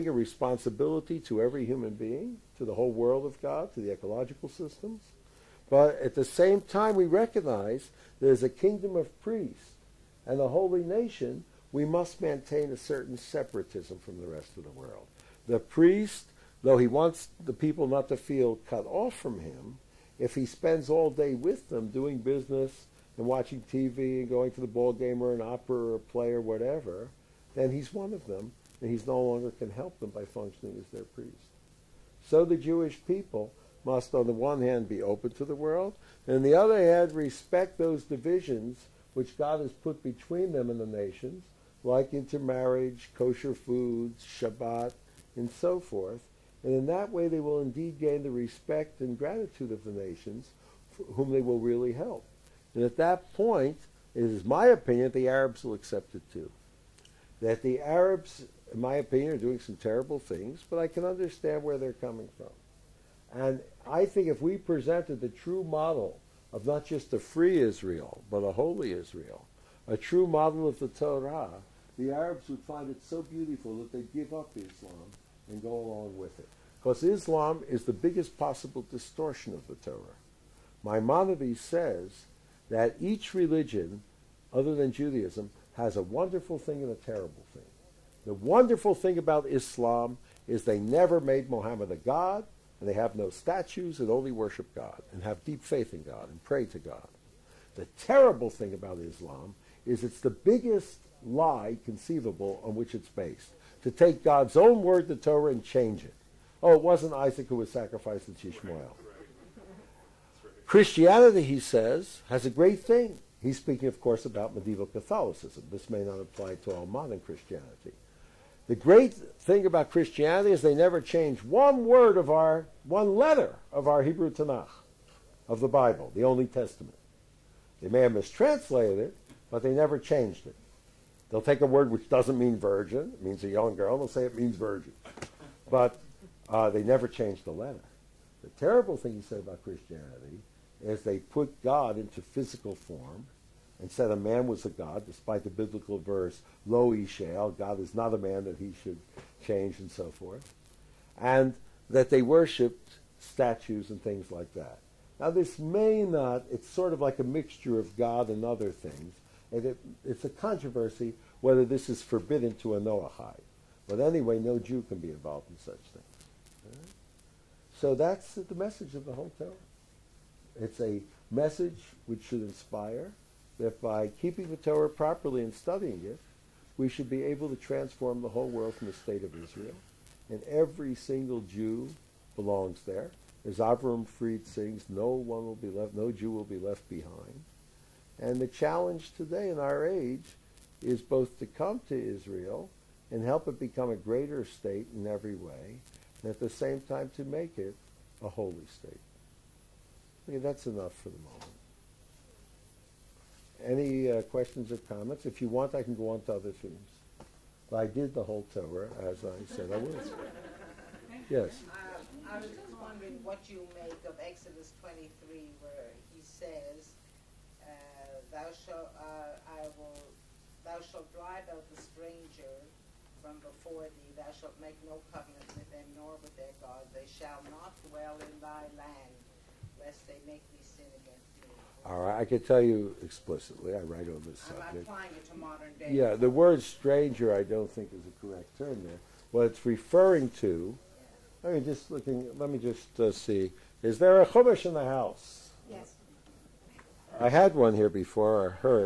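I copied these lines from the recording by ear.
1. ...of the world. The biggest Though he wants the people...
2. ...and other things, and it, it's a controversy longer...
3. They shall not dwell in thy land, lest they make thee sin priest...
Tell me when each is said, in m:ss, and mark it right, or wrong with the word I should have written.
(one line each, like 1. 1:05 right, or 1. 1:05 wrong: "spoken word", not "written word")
1. 0:14 wrong: "priest", not "biggest"
2. 2:38 wrong: "whether", not "longer"
3. 3:46 wrong: "against", not "priest".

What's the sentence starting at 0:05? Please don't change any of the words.
But at the same time, we recognize there's a kingdom of priests and a holy nation.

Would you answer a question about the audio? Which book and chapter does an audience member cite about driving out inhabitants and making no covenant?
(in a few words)
Exodus 23.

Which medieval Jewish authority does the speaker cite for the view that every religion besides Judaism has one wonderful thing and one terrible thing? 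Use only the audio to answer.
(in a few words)
Maimonides.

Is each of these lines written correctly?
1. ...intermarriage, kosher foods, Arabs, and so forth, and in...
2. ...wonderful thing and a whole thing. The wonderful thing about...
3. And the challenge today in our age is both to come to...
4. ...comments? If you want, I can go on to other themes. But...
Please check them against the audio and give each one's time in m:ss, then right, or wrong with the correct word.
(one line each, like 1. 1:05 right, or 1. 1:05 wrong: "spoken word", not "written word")
1. 0:42 wrong: "Shabbat", not "Arabs"
2. 1:26 wrong: "terrible", not "whole"
3. 3:08 right
4. 3:24 right.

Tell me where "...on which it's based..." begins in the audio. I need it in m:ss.
1:42.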